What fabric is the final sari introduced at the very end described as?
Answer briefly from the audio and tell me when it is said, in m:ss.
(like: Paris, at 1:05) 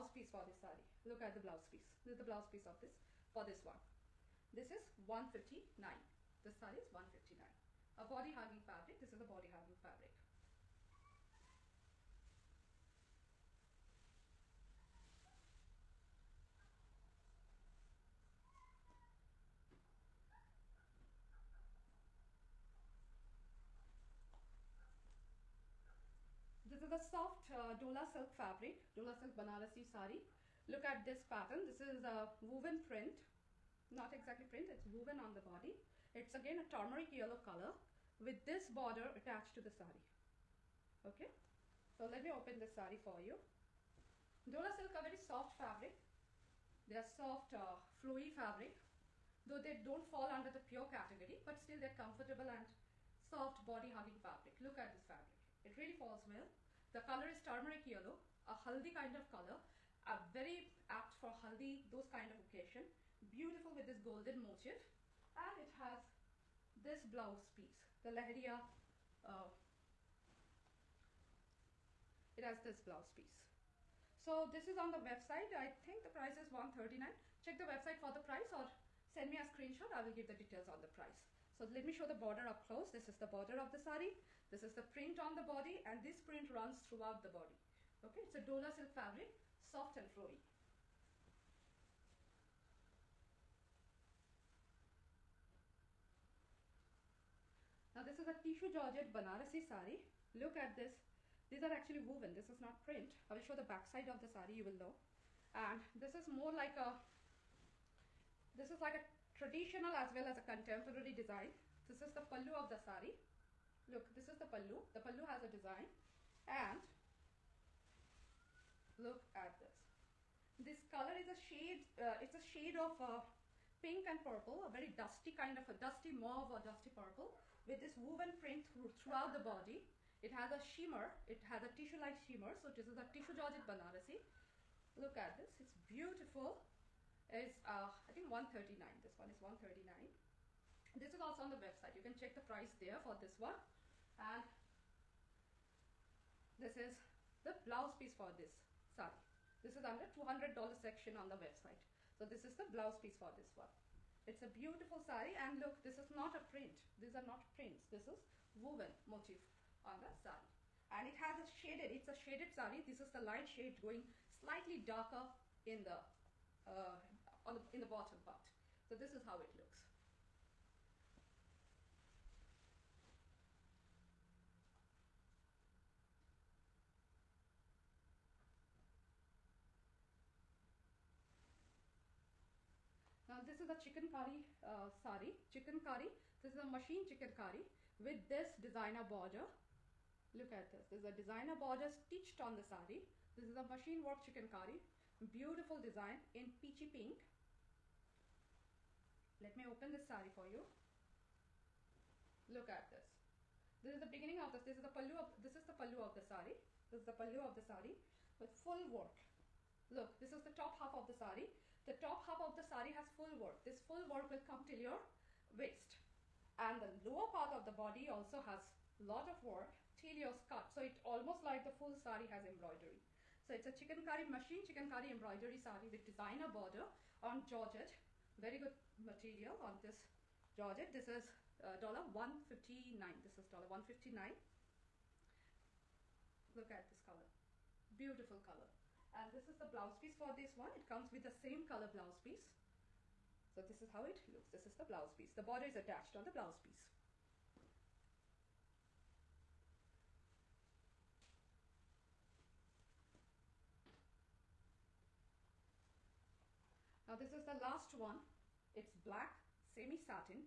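black semi-satin, at 4:19.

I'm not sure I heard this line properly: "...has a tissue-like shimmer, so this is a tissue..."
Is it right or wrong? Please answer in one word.
right.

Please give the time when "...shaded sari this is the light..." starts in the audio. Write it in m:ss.
2:42.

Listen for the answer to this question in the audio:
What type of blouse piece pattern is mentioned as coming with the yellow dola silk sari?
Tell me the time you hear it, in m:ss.
1:08.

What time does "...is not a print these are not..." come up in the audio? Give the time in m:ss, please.
2:36.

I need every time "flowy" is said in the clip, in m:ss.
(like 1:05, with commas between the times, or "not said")
0:48, 1:30.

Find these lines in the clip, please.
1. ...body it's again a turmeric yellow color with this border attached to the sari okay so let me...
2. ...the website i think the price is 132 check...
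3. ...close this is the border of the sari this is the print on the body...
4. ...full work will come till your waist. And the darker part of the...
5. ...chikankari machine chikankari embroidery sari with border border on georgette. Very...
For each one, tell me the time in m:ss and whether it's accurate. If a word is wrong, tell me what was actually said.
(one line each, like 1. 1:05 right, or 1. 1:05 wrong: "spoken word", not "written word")
1. 0:35 right
2. 1:14 wrong: "139", not "132"
3. 1:22 right
4. 3:33 wrong: "lower", not "darker"
5. 3:43 wrong: "designer", not "border".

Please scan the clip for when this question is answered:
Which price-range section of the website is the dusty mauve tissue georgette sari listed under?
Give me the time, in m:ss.
2:29.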